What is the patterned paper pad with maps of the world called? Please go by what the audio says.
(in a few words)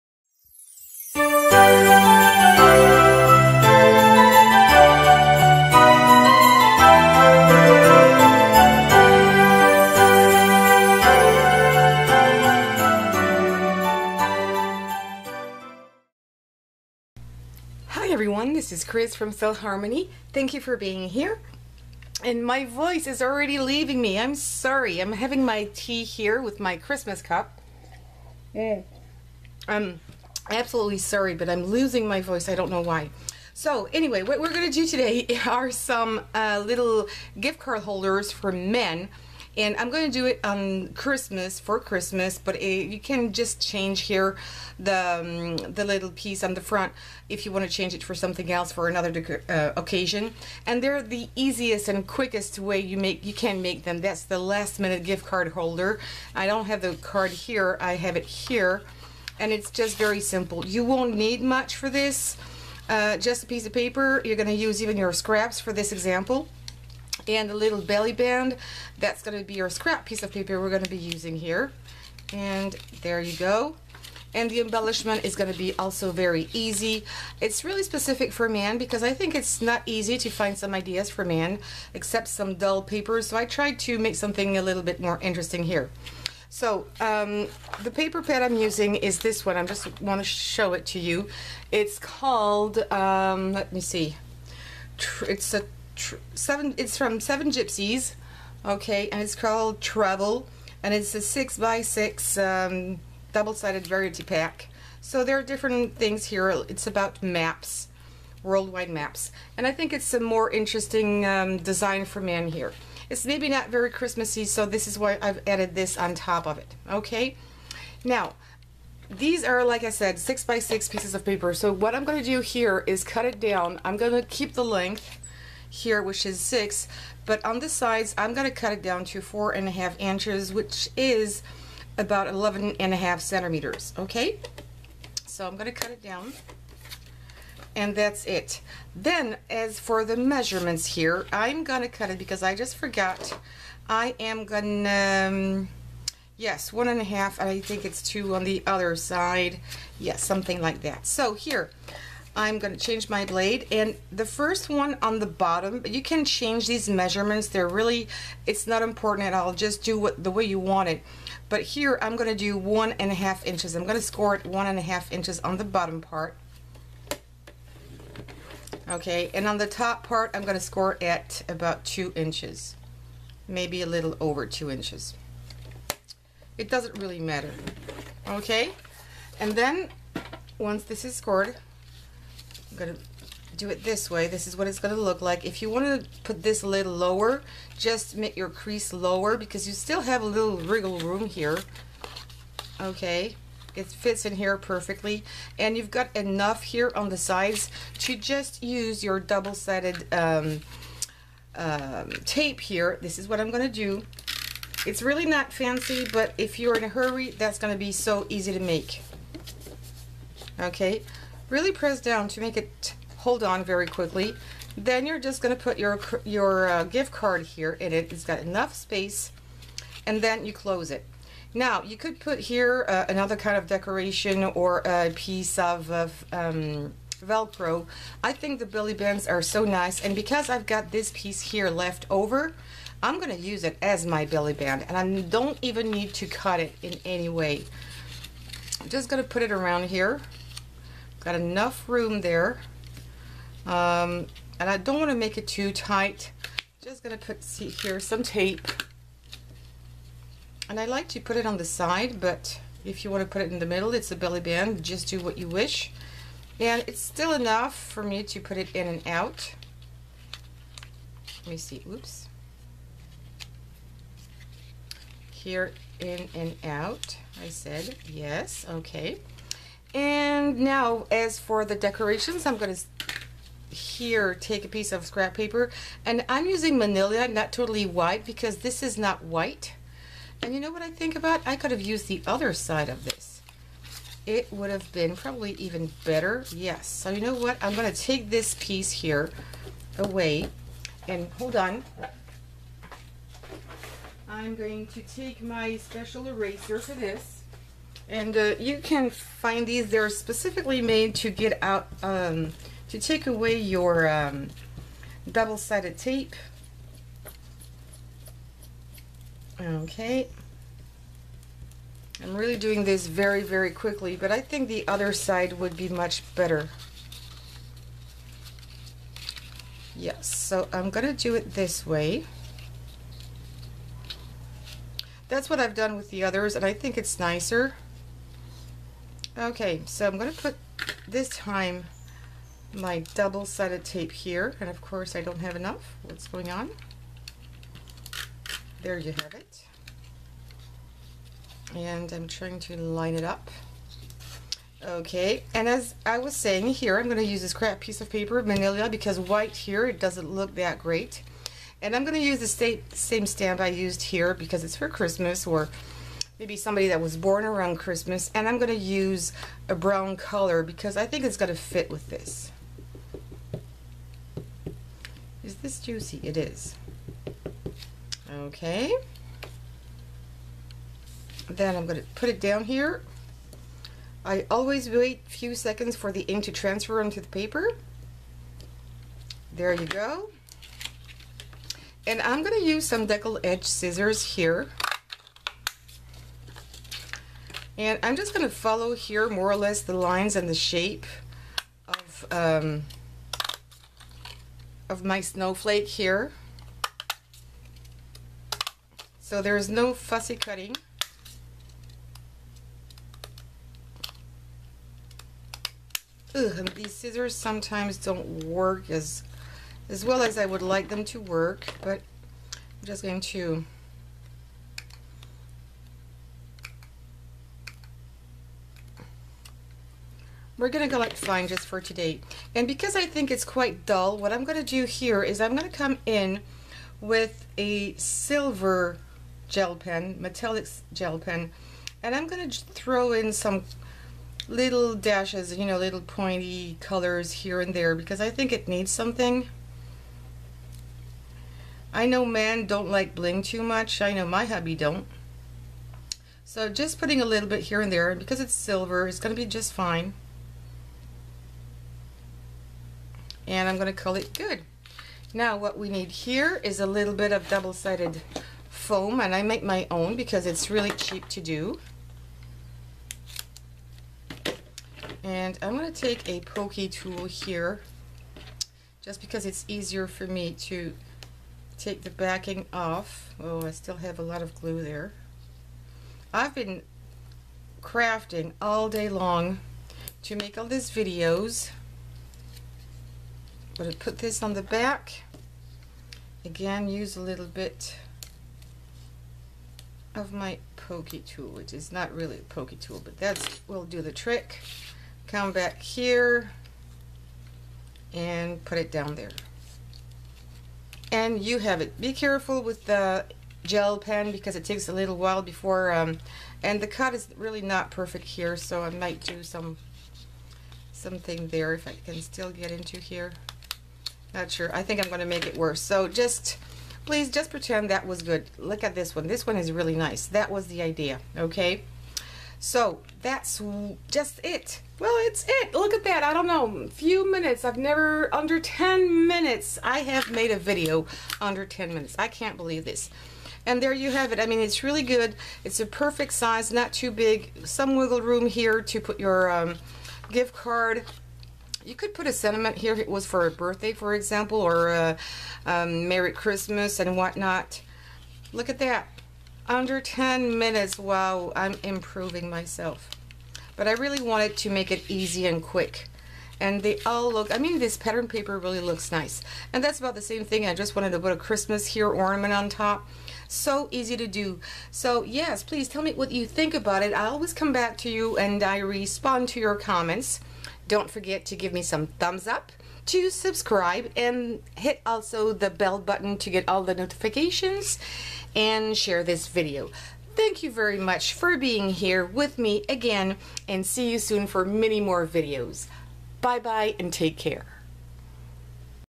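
Travel.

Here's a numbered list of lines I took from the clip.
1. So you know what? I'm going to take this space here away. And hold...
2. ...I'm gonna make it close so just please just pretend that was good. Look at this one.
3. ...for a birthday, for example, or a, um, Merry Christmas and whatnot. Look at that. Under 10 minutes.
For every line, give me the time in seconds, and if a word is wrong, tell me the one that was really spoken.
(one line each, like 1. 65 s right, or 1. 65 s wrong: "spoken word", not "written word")
1. 286 s wrong: "piece", not "space"
2. 515 s wrong: "worse", not "close"
3. 543 s right.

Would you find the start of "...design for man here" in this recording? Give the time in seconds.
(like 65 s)
111 s.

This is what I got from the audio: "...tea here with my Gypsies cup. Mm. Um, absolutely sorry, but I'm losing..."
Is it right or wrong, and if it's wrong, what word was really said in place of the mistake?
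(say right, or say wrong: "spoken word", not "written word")
wrong: "Christmas", not "Gypsies".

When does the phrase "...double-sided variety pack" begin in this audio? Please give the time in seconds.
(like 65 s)
103 s.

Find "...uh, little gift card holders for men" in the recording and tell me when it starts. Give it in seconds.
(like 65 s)
36 s.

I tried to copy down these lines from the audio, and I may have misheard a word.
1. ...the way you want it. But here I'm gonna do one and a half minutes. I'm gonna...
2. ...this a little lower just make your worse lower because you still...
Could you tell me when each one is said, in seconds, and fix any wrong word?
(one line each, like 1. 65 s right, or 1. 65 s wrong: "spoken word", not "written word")
1. 160 s wrong: "inches", not "minutes"
2. 186 s wrong: "crease", not "worse".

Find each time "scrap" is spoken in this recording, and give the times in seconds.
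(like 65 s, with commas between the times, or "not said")
65 s, 69 s, 275 s, 347 s.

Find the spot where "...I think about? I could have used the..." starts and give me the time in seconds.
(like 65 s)
280 s.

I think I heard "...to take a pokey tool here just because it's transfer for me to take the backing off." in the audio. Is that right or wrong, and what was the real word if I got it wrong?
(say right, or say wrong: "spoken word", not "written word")
wrong: "easier", not "transfer".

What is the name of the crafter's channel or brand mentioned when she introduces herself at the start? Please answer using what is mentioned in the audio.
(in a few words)
StylHarmony.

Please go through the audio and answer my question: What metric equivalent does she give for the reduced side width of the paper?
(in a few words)
11.5 centimeters.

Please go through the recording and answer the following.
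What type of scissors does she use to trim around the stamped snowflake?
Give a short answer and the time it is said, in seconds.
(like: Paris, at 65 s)
deckle edge scissors, at 383 s.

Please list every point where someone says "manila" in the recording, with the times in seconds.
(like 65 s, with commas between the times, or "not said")
276 s, 348 s.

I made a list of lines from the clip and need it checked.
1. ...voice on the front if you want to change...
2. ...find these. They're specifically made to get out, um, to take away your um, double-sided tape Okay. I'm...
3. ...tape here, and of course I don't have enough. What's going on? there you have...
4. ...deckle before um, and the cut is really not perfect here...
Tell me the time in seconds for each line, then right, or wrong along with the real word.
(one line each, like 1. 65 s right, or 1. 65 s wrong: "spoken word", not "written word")
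1. 46 s wrong: "piece", not "voice"
2. 299 s right
3. 333 s right
4. 505 s wrong: "while", not "deckle".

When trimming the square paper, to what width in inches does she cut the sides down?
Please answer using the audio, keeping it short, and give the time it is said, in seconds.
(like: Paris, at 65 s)
4.5 inches, at 129 s.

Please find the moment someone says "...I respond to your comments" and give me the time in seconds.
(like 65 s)
568 s.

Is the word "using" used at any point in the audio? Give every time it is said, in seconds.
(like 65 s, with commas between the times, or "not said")
70 s, 88 s, 276 s.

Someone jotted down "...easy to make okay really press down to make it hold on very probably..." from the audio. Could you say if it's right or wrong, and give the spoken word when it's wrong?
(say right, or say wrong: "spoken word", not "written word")
wrong: "quickly", not "probably".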